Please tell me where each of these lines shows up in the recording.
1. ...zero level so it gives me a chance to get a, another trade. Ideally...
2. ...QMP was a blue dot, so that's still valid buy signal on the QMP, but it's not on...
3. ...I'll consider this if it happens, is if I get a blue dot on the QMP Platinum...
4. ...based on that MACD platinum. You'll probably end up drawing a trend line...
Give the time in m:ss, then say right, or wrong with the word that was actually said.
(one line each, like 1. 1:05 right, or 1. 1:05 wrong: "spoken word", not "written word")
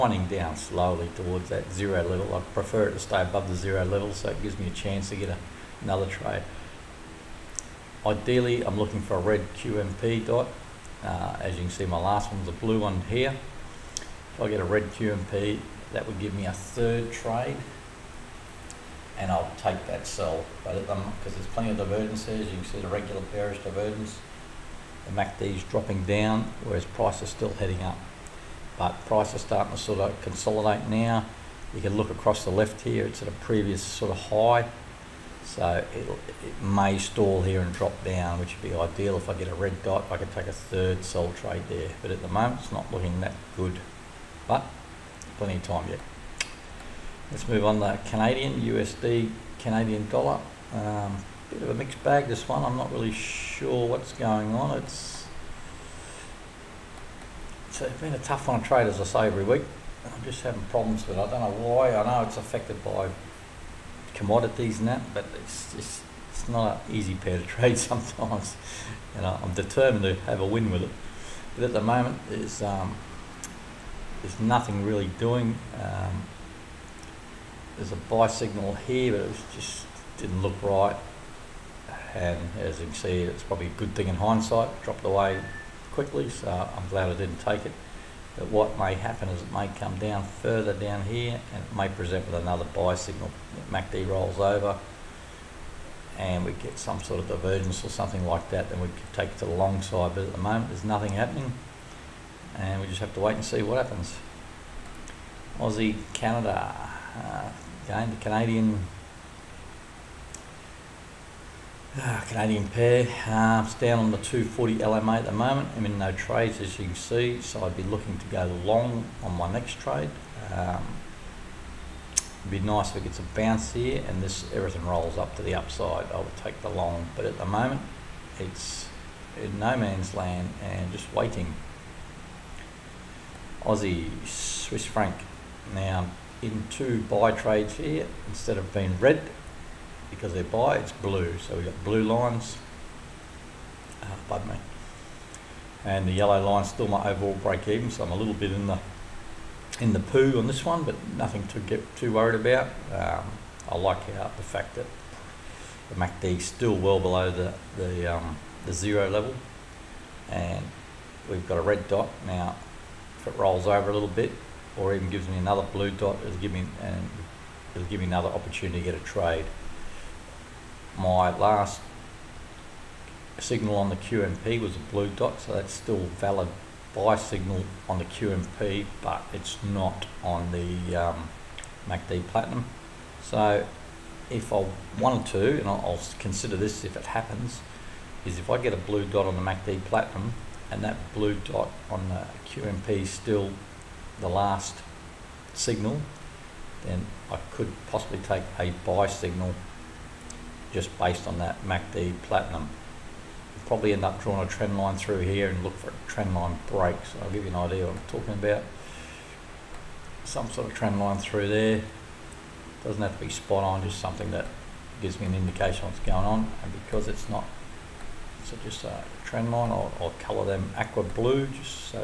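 1. 0:03 right
2. 2:53 right
3. 3:05 wrong: "MACD", not "QMP"
4. 3:20 right.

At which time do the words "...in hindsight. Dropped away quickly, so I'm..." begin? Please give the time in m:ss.
1:24.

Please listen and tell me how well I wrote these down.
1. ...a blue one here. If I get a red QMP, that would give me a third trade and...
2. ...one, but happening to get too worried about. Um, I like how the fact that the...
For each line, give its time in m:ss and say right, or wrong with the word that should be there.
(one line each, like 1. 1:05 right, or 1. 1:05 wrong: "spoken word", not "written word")
1. 0:12 right
2. 2:30 wrong: "nothing", not "happening".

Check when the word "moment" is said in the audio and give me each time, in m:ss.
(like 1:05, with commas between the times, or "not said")
0:42, 1:11, 1:40, 1:55, 2:07.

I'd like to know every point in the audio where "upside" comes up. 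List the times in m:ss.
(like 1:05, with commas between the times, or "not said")
2:05.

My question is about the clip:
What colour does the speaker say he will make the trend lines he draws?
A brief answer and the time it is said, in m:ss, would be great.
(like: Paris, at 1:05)
Aqua blue, at 3:40.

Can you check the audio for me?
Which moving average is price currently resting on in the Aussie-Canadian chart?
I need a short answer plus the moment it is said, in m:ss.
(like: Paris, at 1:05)
240 LMA, at 1:54.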